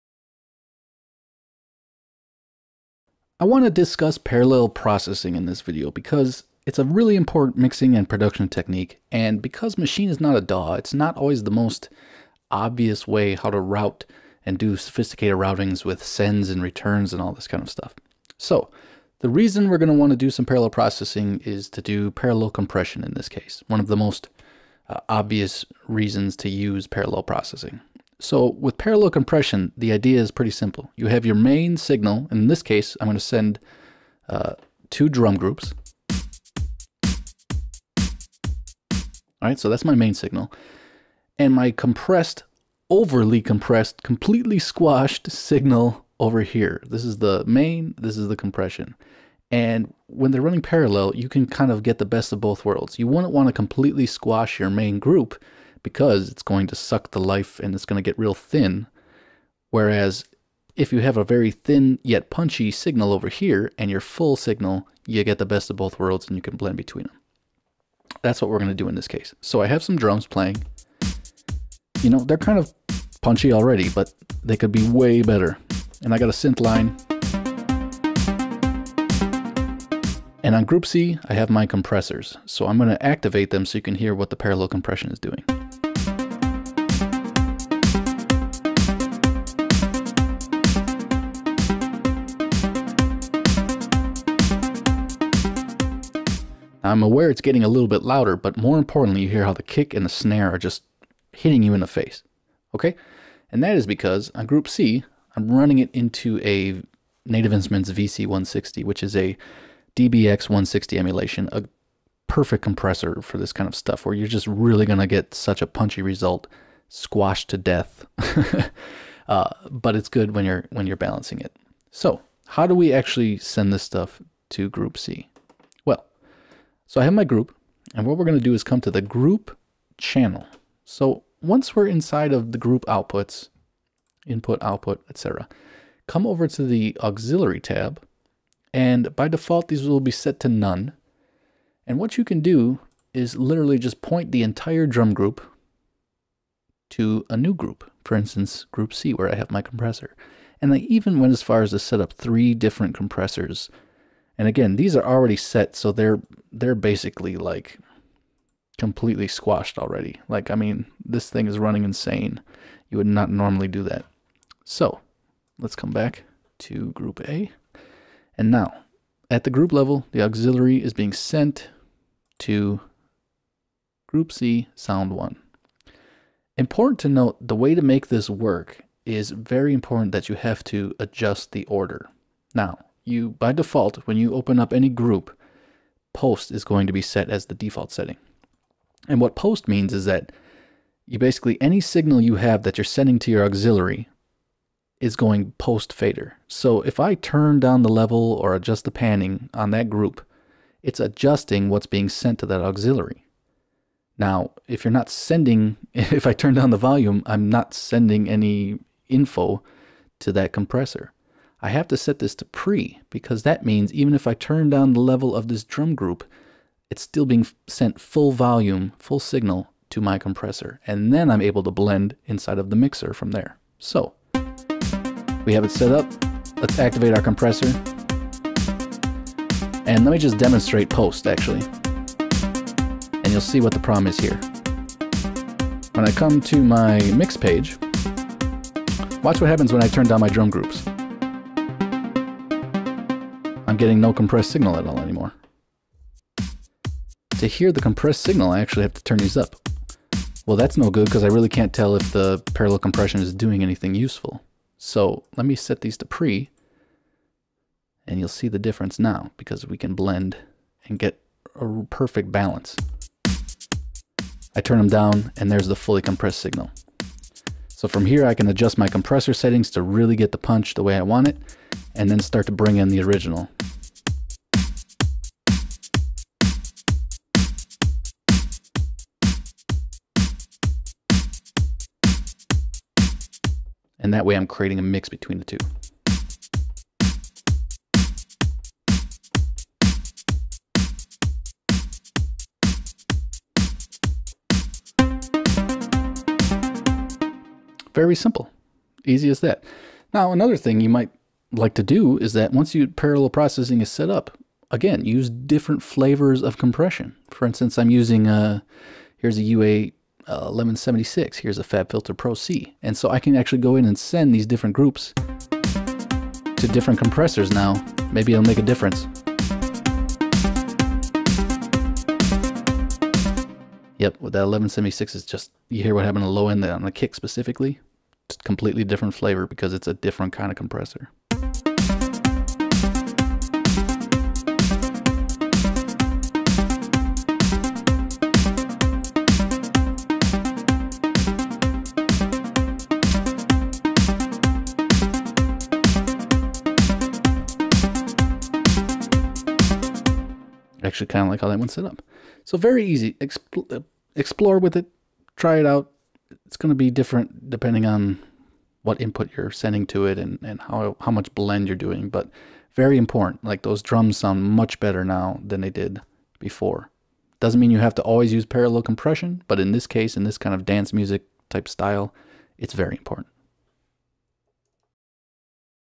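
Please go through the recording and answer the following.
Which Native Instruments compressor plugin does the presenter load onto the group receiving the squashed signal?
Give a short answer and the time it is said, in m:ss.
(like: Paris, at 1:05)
VC160, at 1:47.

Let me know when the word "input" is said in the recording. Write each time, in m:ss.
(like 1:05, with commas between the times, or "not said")
2:14, 5:58.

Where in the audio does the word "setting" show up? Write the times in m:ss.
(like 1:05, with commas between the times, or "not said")
3:07, 4:29.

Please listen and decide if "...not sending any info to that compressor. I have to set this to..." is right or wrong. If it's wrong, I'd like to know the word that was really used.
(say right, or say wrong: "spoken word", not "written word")
right.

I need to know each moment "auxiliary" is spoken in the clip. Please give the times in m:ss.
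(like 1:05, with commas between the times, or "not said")
2:16, 2:50, 3:13, 3:22.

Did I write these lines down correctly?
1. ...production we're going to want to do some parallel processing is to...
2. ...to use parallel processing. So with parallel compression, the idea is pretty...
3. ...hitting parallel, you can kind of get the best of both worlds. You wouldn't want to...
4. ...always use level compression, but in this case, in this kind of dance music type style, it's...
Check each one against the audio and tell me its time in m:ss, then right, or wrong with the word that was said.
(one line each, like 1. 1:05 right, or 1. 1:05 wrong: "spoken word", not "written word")
1. 0:19 wrong: "reason", not "production"
2. 0:26 right
3. 0:50 wrong: "running", not "hitting"
4. 6:08 wrong: "parallel", not "level".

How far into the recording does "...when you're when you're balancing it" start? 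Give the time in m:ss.
2:00.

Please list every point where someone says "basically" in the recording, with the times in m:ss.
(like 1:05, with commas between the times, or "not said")
2:36, 3:11.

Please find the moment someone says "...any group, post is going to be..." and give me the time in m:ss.
3:04.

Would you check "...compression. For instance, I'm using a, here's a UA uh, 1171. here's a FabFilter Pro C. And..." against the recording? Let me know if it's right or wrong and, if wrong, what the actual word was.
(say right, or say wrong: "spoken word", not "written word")
wrong: "1176", not "1171".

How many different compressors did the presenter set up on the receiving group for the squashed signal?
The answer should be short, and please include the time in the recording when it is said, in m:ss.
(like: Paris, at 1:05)
3, at 2:32.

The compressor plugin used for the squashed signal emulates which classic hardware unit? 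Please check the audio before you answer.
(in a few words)
DBX 160.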